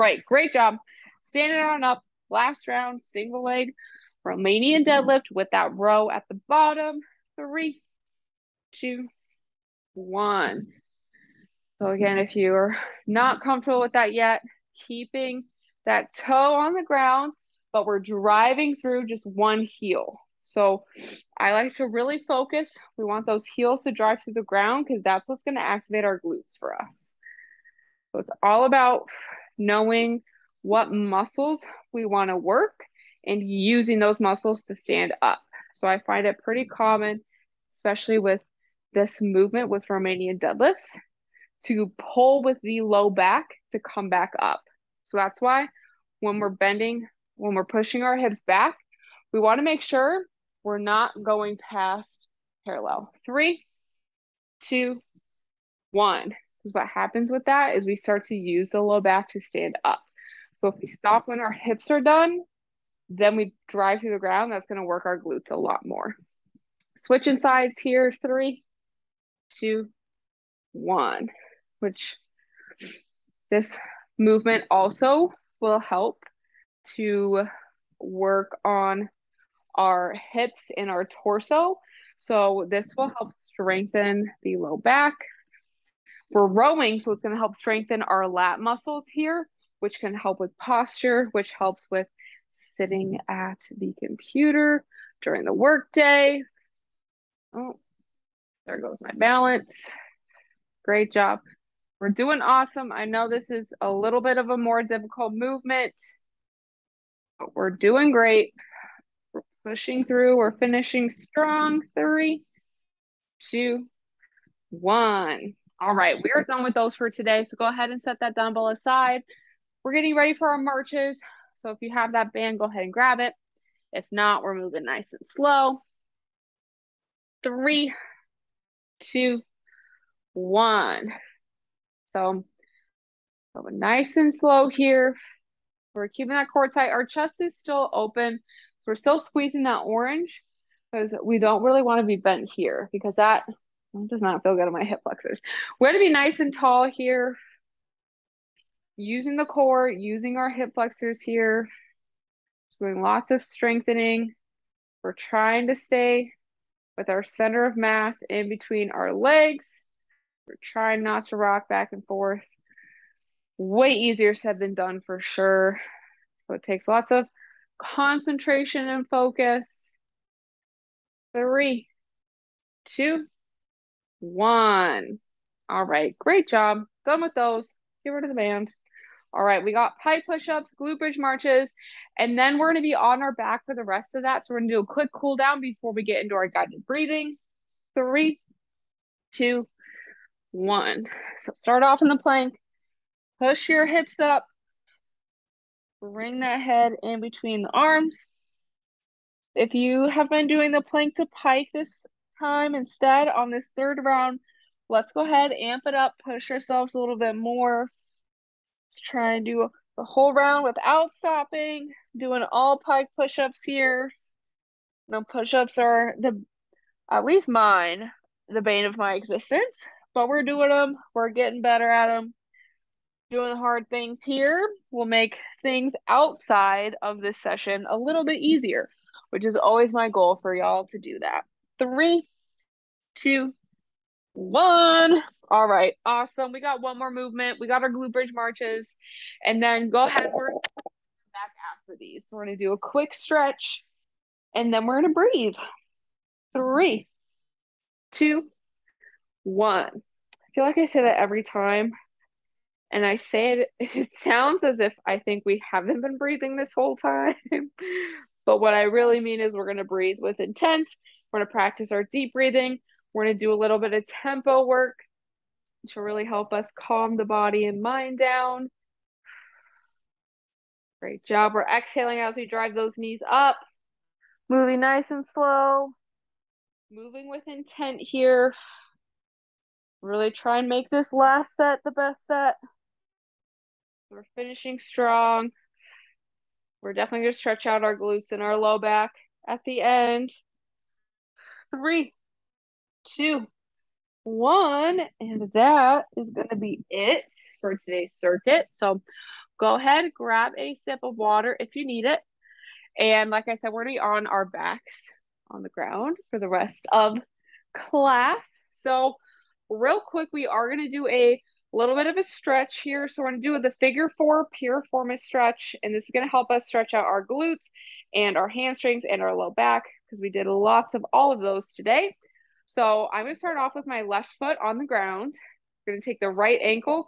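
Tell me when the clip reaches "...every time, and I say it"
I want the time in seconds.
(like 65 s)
251 s.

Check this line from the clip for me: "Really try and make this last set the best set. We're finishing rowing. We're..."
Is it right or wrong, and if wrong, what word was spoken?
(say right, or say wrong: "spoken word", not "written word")
wrong: "strong", not "rowing".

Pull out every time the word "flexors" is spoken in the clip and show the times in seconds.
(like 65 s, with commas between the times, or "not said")
145 s, 150 s.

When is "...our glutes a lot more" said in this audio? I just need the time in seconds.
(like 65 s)
65 s.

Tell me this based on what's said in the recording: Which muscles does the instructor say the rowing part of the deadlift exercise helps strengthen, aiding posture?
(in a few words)
lat muscles.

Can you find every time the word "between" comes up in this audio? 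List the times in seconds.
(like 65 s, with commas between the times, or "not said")
158 s, 197 s.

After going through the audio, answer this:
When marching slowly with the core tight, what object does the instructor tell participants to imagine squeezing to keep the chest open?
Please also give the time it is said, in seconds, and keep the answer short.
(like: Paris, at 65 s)
orange, at 139 s.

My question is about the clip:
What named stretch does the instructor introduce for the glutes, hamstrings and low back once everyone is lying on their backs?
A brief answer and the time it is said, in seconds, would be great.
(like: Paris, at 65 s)
figure four piriformis stretch, at 313 s.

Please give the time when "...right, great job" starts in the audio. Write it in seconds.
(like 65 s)
175 s.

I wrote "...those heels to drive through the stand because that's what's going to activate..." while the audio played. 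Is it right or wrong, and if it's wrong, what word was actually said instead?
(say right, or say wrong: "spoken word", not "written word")
wrong: "ground", not "stand".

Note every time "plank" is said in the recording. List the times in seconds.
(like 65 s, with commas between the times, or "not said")
192 s, 200 s.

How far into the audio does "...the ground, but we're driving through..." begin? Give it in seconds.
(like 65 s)
16 s.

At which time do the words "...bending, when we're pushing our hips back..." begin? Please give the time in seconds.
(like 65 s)
46 s.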